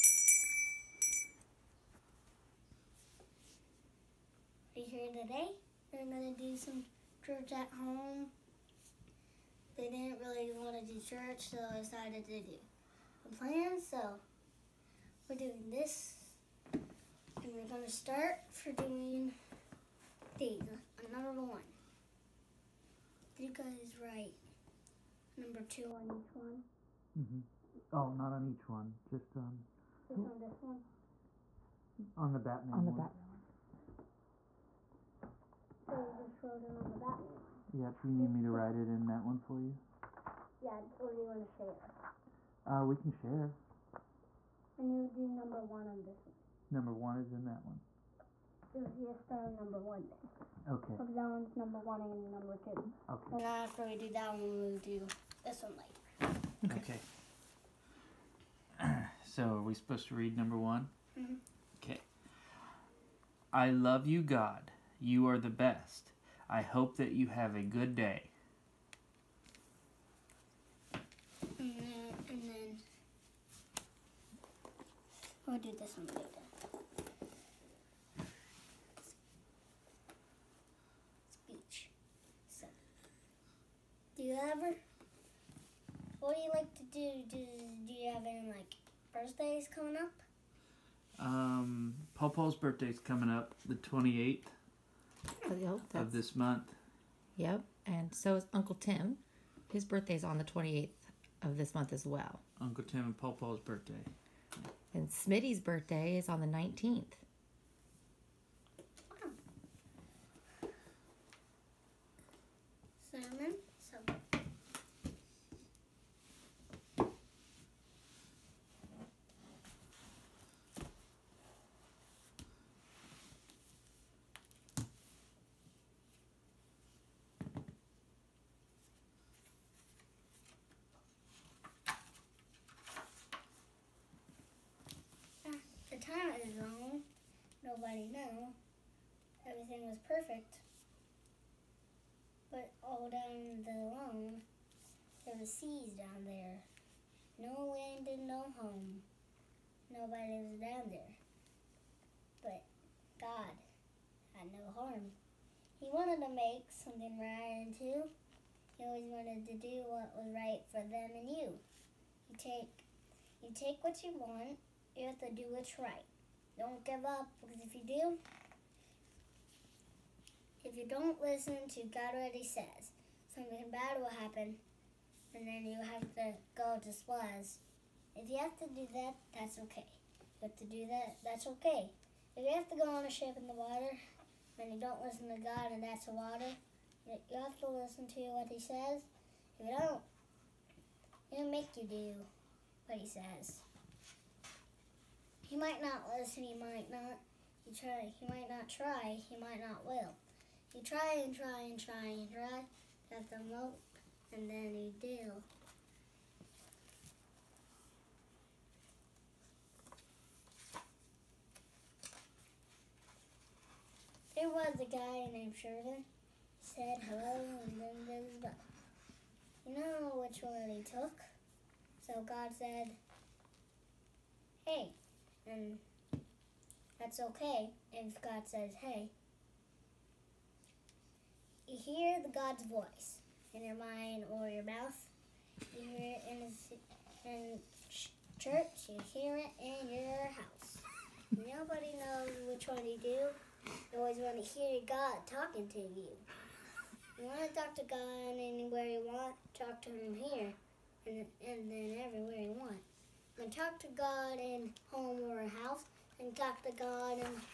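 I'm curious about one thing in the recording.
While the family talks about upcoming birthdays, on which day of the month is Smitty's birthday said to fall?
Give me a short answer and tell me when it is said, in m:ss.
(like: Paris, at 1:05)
19th, at 1:46.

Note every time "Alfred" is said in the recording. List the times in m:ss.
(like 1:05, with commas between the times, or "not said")
not said.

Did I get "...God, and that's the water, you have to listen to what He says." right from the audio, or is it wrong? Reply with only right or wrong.
right.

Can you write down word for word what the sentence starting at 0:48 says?
Let's just start on number one then.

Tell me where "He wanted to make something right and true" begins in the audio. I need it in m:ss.
2:35.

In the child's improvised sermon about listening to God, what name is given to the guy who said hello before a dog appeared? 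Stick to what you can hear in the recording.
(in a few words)
Sheridan.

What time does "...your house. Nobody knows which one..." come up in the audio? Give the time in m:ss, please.
3:59.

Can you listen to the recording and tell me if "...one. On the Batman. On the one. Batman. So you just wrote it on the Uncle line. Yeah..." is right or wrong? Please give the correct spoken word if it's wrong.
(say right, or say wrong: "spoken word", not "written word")
wrong: "Batman", not "Uncle".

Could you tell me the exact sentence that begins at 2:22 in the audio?
But all down the line there was seas down there.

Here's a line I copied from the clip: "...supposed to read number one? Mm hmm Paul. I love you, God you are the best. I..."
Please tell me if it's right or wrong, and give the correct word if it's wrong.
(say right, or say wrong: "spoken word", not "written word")
wrong: "Okay", not "Paul".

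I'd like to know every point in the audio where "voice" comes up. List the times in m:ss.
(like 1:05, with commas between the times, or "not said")
3:52.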